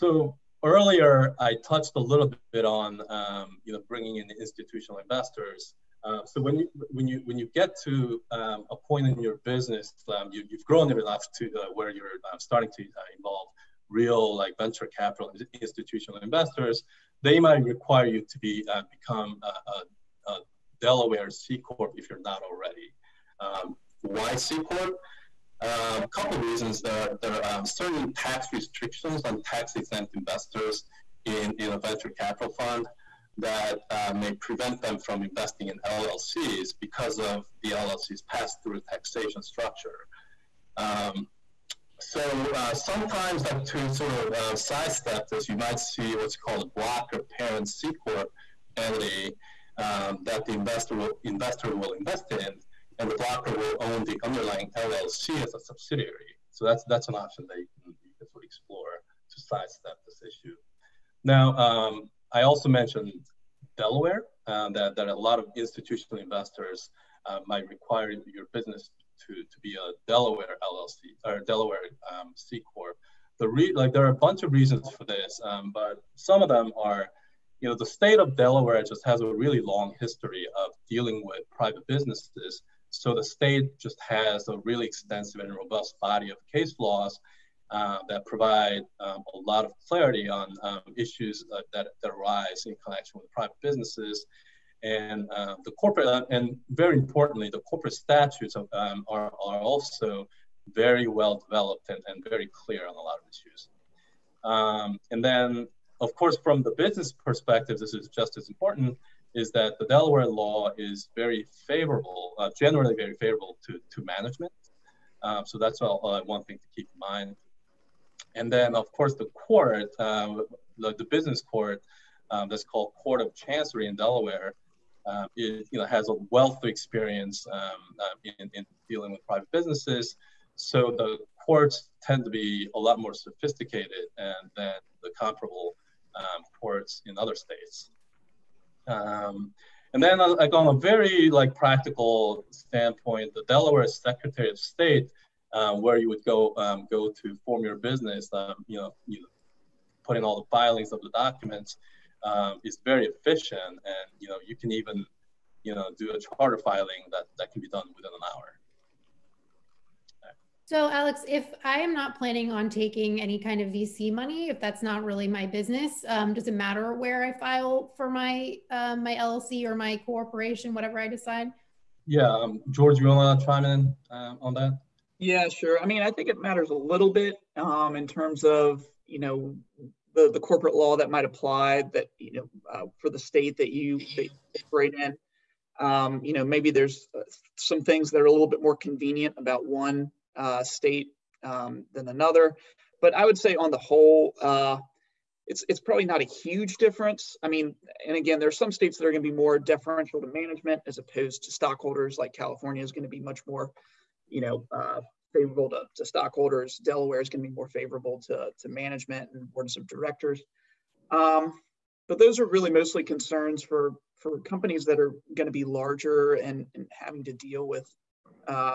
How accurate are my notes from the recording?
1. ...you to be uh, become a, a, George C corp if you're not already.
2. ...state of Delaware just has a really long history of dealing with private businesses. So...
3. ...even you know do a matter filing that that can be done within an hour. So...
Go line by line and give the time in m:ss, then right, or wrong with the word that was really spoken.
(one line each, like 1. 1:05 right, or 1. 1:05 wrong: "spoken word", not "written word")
1. 0:18 wrong: "Delaware", not "George"
2. 1:17 right
3. 2:34 wrong: "charter", not "matter".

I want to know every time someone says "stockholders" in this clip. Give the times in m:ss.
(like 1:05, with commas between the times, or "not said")
3:21, 3:26.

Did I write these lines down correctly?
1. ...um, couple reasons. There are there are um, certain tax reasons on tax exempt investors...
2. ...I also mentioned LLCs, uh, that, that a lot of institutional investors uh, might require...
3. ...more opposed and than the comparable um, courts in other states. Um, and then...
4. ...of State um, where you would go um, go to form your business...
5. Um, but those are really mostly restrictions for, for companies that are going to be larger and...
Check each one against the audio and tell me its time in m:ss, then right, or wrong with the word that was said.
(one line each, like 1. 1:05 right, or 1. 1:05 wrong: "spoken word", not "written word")
1. 0:25 wrong: "restrictions", not "reasons"
2. 1:02 wrong: "Delaware", not "LLCs"
3. 2:12 wrong: "sophisticated", not "opposed"
4. 2:24 right
5. 3:31 wrong: "concerns", not "restrictions".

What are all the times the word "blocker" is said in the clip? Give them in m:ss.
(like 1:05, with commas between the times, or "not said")
0:46, 0:53.